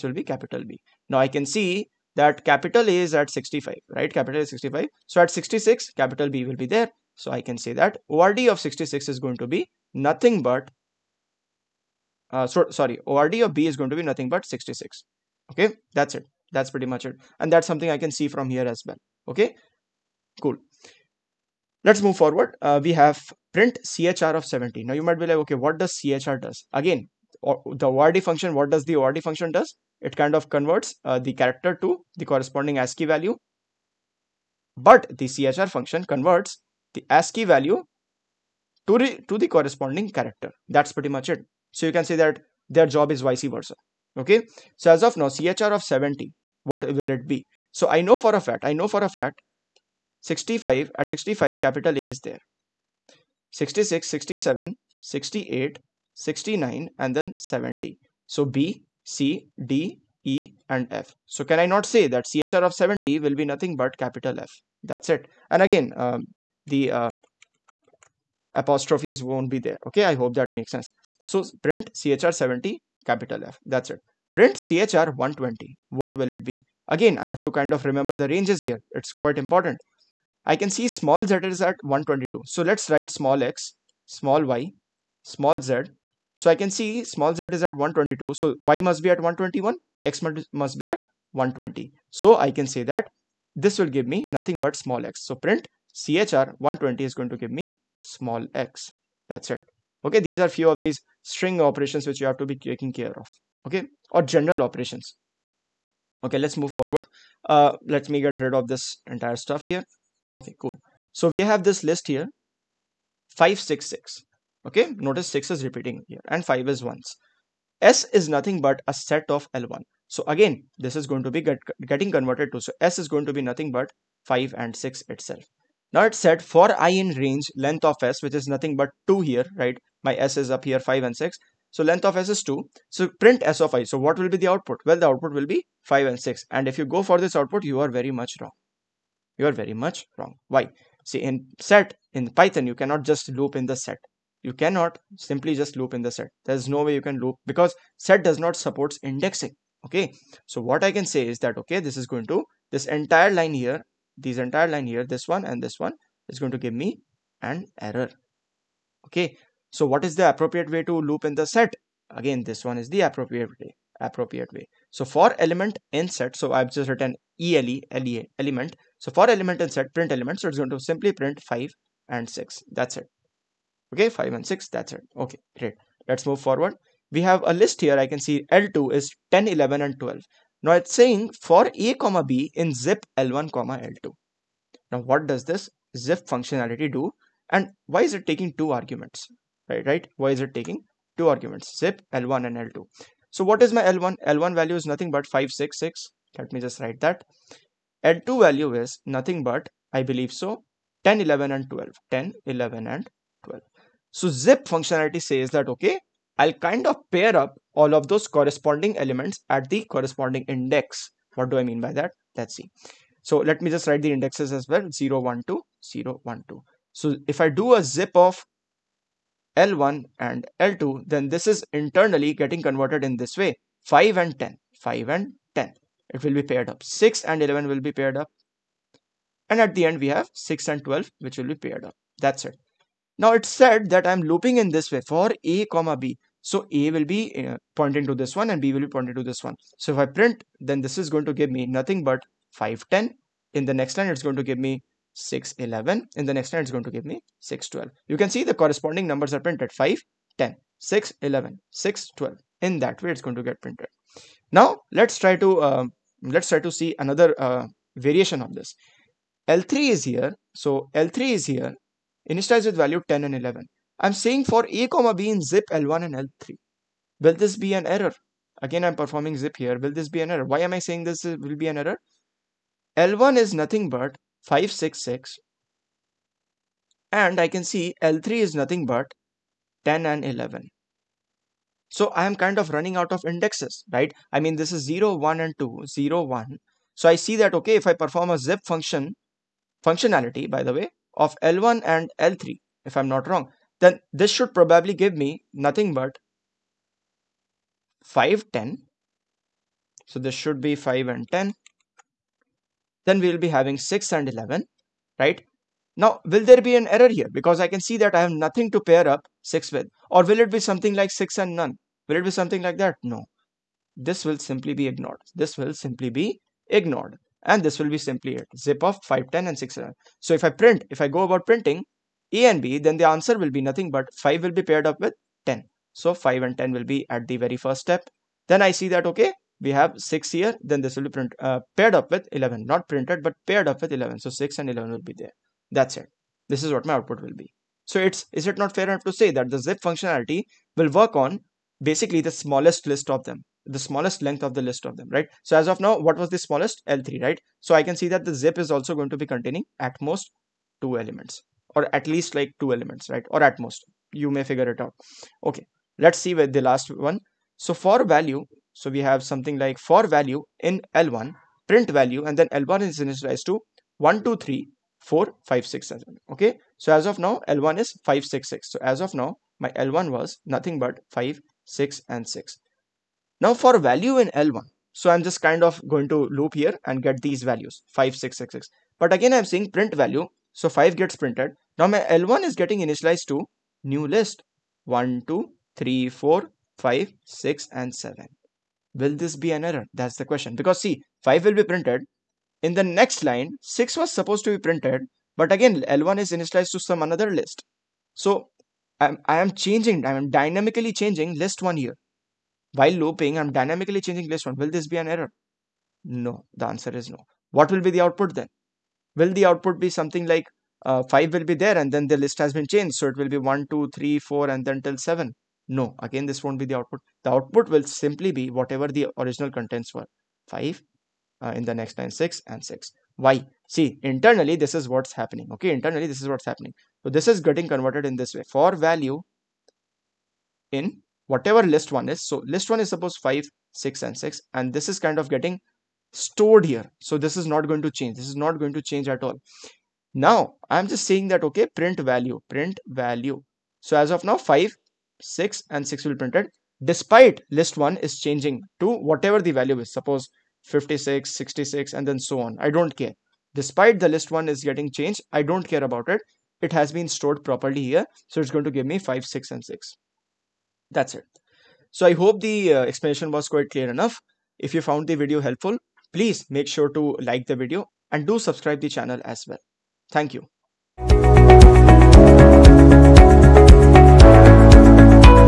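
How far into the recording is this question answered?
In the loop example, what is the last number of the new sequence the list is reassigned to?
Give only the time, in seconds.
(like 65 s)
384 s.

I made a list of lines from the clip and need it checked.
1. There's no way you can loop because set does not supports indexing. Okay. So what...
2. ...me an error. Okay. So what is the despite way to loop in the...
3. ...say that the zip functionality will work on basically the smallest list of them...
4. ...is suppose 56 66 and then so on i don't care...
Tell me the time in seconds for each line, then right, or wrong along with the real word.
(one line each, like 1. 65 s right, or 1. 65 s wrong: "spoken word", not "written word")
1. 146 s right
2. 156 s wrong: "appropriate", not "despite"
3. 339 s right
4. 449 s right.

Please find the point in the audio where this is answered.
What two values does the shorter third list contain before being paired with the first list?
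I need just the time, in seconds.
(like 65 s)
262 s.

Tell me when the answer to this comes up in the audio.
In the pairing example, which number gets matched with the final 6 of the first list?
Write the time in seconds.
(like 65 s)
229 s.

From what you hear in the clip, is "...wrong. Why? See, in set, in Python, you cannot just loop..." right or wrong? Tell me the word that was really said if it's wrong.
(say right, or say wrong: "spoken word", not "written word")
right.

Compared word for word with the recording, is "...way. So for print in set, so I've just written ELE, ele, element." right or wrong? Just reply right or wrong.
wrong.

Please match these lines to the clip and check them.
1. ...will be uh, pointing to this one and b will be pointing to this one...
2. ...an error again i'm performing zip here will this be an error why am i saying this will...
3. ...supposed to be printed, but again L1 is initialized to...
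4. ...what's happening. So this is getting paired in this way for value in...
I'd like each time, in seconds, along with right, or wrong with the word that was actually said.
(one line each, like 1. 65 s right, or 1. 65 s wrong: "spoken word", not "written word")
1. 236 s right
2. 267 s right
3. 394 s right
4. 426 s wrong: "converted", not "paired".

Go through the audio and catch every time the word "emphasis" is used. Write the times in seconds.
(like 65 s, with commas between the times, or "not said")
not said.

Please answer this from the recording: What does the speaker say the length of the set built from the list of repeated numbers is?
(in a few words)
2.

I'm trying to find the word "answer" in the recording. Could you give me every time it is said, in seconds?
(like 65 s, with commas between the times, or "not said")
323 s, 406 s.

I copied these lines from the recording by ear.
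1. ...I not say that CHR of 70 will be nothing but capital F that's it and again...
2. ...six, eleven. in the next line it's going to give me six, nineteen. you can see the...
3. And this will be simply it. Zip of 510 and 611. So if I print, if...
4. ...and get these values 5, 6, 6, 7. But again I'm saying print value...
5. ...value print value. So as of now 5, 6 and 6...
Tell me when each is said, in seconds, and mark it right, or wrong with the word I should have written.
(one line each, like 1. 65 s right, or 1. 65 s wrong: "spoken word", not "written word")
1. 61 s right
2. 245 s wrong: "twelve", not "nineteen"
3. 317 s right
4. 376 s wrong: "6", not "7"
5. 441 s right.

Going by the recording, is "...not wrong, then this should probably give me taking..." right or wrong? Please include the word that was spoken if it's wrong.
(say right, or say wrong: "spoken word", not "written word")
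wrong: "nothing", not "taking".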